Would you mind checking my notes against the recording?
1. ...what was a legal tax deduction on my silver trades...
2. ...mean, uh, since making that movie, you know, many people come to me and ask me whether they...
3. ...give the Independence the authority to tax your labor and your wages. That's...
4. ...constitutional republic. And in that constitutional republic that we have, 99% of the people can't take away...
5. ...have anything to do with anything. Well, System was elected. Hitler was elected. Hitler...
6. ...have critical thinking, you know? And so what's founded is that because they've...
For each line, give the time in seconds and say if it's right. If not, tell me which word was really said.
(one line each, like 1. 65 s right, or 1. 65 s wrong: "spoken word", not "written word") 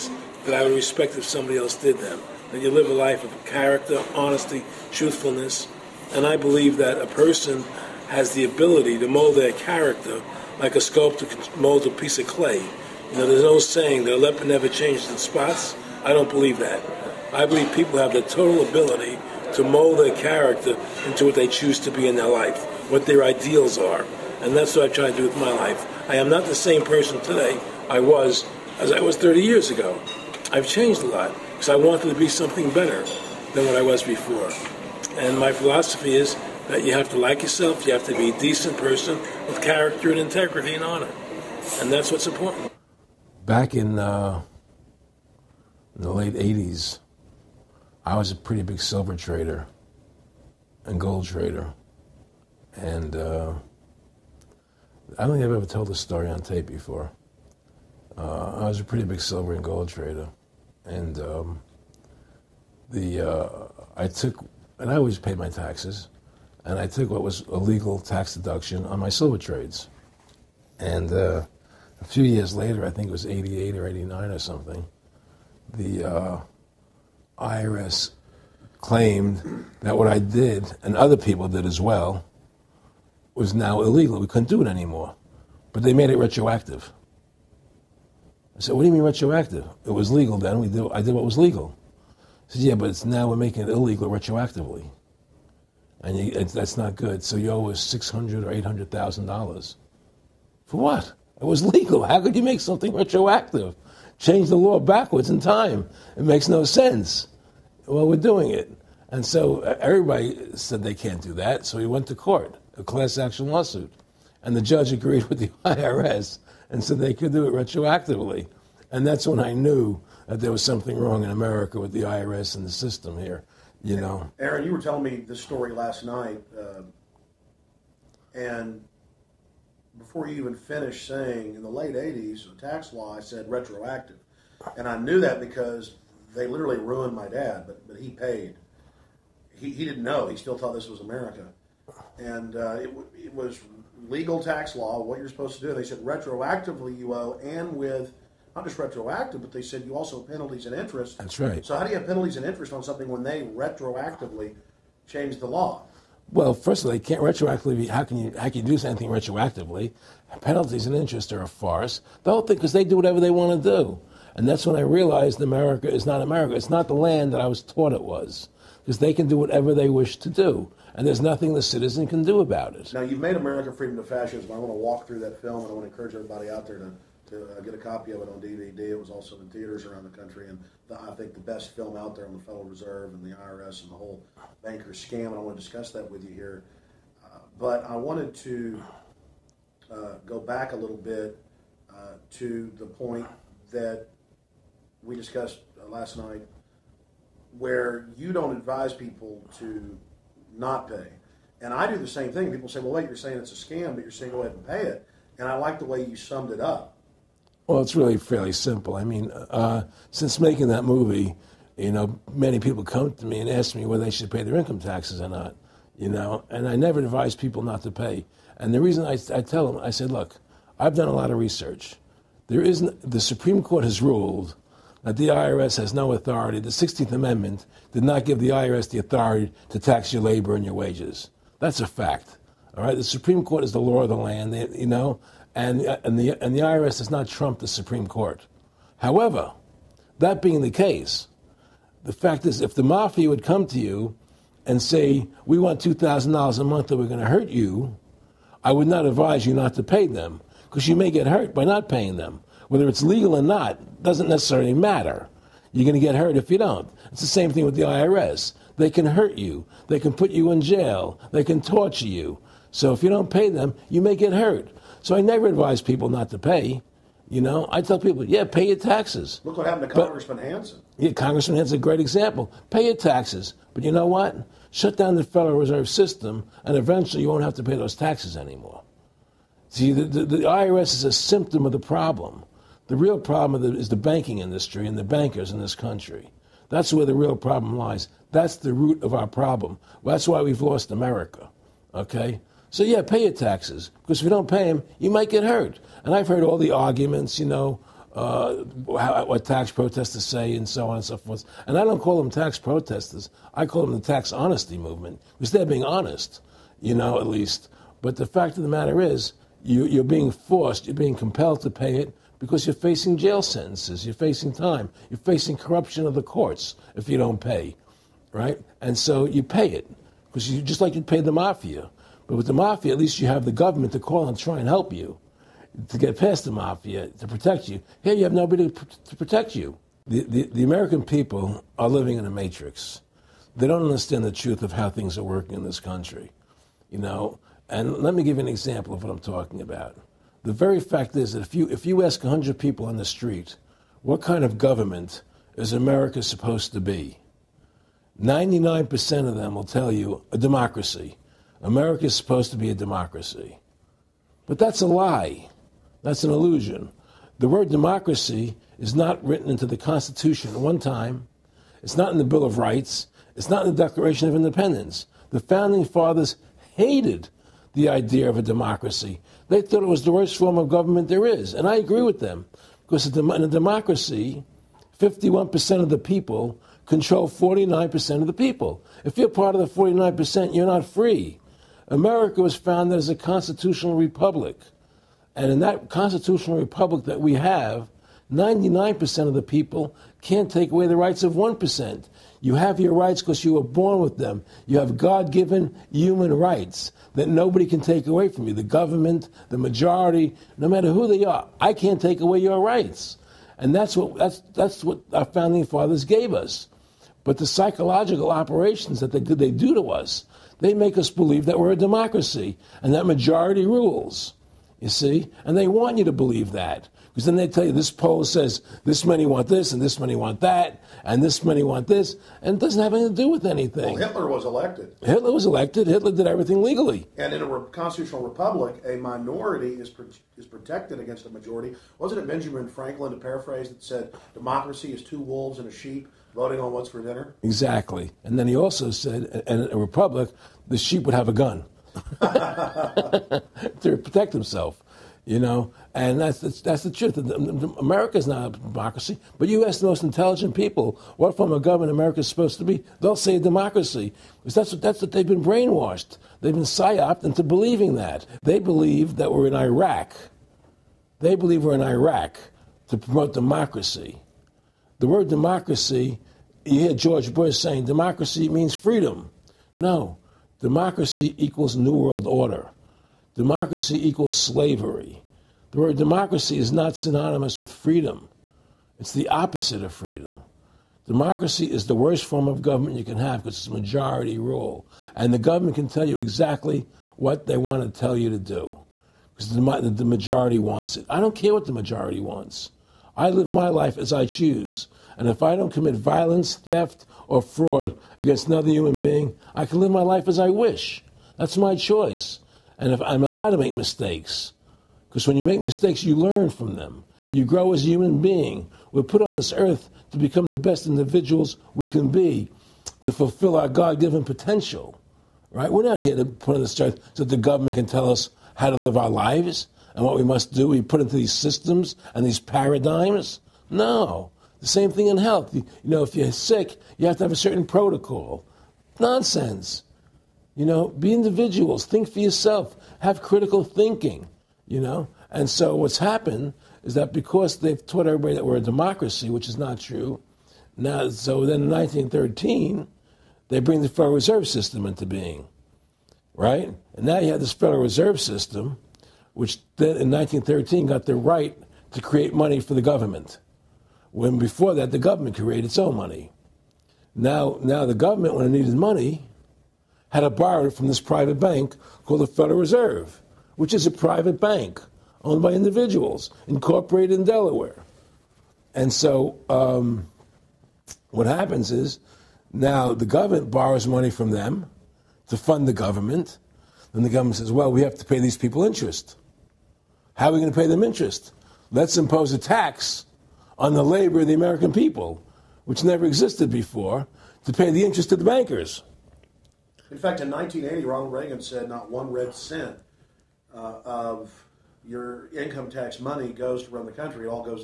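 1. 67 s right
2. 209 s right
3. 228 s wrong: "IRS", not "Independence"
4. 383 s right
5. 422 s wrong: "Hitler", not "System"
6. 532 s wrong: "happened", not "founded".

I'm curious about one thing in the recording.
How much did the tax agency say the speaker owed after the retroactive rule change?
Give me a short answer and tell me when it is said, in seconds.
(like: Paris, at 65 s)
600 or $800,000, at 97 s.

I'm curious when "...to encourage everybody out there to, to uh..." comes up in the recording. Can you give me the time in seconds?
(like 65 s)
175 s.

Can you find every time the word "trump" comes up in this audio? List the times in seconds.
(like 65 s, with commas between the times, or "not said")
237 s.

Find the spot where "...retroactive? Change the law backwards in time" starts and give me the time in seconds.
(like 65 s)
102 s.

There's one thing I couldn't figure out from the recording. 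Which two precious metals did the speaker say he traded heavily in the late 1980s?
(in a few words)
silver and gold.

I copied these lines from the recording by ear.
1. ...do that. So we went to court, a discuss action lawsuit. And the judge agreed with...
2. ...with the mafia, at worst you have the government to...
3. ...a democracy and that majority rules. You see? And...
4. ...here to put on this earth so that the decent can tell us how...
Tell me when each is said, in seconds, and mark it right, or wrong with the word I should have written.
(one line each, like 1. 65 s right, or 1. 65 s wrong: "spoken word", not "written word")
1. 111 s wrong: "class", not "discuss"
2. 322 s wrong: "least", not "worst"
3. 411 s right
4. 516 s wrong: "government", not "decent".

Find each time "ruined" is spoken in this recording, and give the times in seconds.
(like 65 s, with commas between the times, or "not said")
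136 s.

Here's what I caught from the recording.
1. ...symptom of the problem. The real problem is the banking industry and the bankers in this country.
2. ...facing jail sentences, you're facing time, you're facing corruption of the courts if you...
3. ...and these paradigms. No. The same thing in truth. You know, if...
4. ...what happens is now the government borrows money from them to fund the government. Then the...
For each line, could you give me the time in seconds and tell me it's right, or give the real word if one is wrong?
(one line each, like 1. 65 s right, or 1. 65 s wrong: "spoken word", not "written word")
1. 281 s right
2. 312 s right
3. 522 s wrong: "health", not "truth"
4. 571 s right.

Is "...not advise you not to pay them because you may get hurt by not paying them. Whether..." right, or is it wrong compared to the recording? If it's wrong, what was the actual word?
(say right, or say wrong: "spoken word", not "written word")
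right.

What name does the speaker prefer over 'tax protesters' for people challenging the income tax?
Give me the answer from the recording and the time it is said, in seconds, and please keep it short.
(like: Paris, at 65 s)
tax honesty movement, at 304 s.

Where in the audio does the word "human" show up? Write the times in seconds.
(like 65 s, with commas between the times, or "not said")
395 s, 498 s, 507 s.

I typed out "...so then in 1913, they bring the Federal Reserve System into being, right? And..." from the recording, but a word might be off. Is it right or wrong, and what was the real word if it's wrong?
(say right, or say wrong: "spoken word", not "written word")
right.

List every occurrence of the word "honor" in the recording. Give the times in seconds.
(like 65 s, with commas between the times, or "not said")
40 s.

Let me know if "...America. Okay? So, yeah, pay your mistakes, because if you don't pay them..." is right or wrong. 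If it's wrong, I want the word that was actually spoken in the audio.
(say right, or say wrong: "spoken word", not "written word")
wrong: "taxes", not "mistakes".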